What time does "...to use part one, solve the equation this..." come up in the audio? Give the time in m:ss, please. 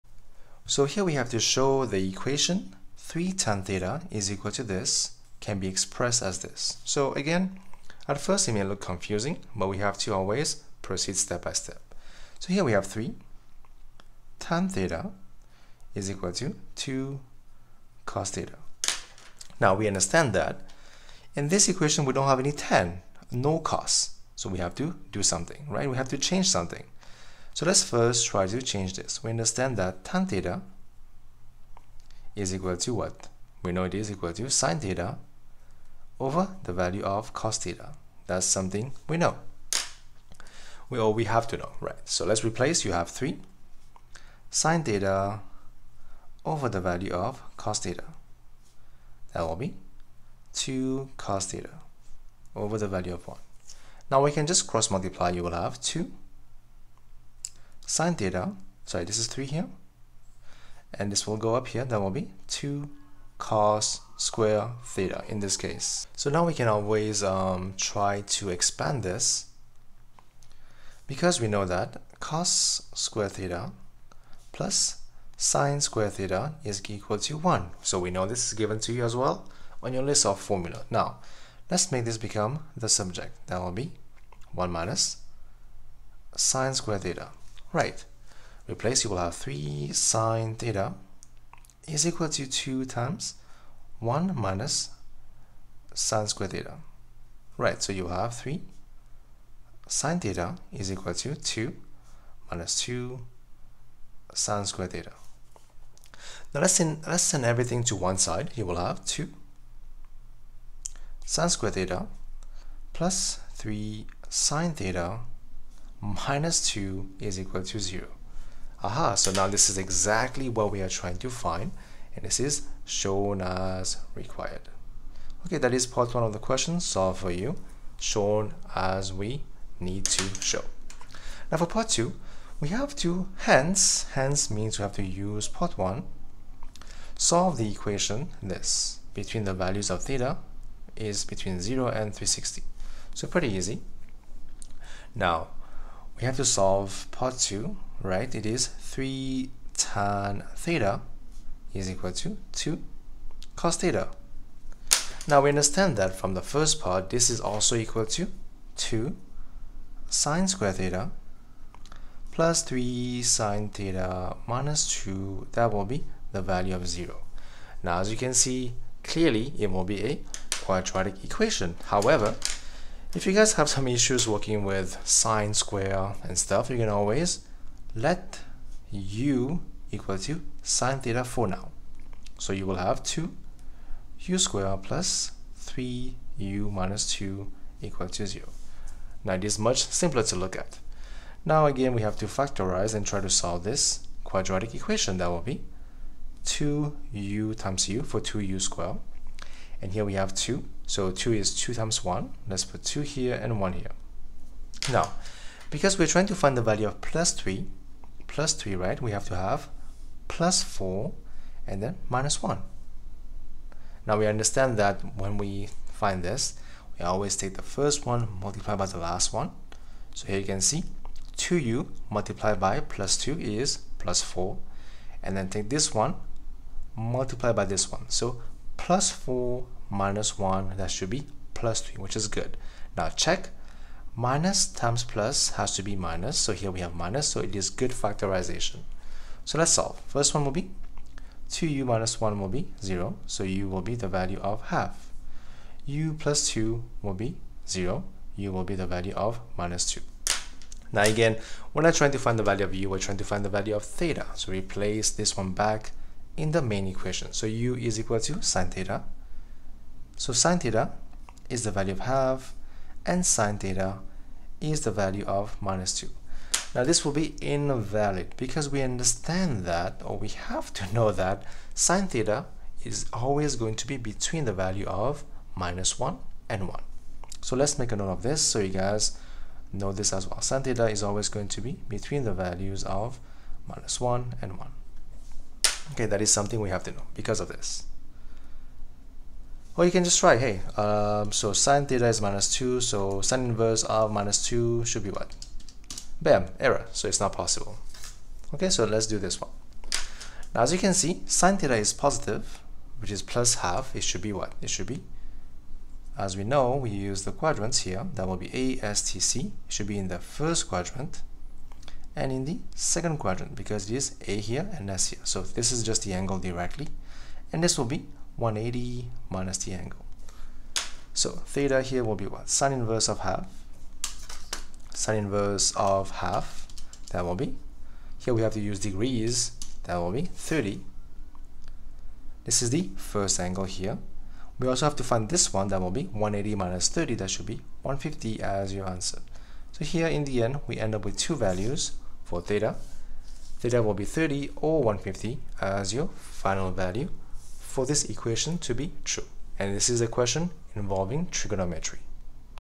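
2:14.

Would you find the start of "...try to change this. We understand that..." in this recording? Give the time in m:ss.
0:28.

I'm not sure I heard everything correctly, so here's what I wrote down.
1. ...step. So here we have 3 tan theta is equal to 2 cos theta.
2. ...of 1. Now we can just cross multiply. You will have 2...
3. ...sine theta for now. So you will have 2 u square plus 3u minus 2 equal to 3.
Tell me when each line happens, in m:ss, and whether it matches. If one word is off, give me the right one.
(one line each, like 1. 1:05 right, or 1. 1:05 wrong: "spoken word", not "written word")
1. 0:11 right
2. 0:53 right
3. 3:00 wrong: "0", not "3".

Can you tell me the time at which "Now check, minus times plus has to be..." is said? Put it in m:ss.
3:52.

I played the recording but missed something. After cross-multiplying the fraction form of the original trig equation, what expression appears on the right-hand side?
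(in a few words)
2 cos squared theta.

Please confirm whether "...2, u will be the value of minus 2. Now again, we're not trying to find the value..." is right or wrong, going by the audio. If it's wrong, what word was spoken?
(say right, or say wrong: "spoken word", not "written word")
wrong: "0", not "2".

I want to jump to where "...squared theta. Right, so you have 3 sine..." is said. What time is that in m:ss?
1:36.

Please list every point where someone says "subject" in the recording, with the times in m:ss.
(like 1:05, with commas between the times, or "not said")
1:22.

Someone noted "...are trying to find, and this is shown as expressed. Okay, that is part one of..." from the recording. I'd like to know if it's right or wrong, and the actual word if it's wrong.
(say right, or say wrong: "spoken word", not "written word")
wrong: "required", not "expressed".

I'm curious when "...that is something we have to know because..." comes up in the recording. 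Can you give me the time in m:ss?
4:46.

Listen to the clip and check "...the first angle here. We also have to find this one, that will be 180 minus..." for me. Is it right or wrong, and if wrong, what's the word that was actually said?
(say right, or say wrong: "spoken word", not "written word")
right.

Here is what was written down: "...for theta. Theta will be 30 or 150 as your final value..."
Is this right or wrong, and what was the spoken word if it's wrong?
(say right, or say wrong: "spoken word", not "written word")
right.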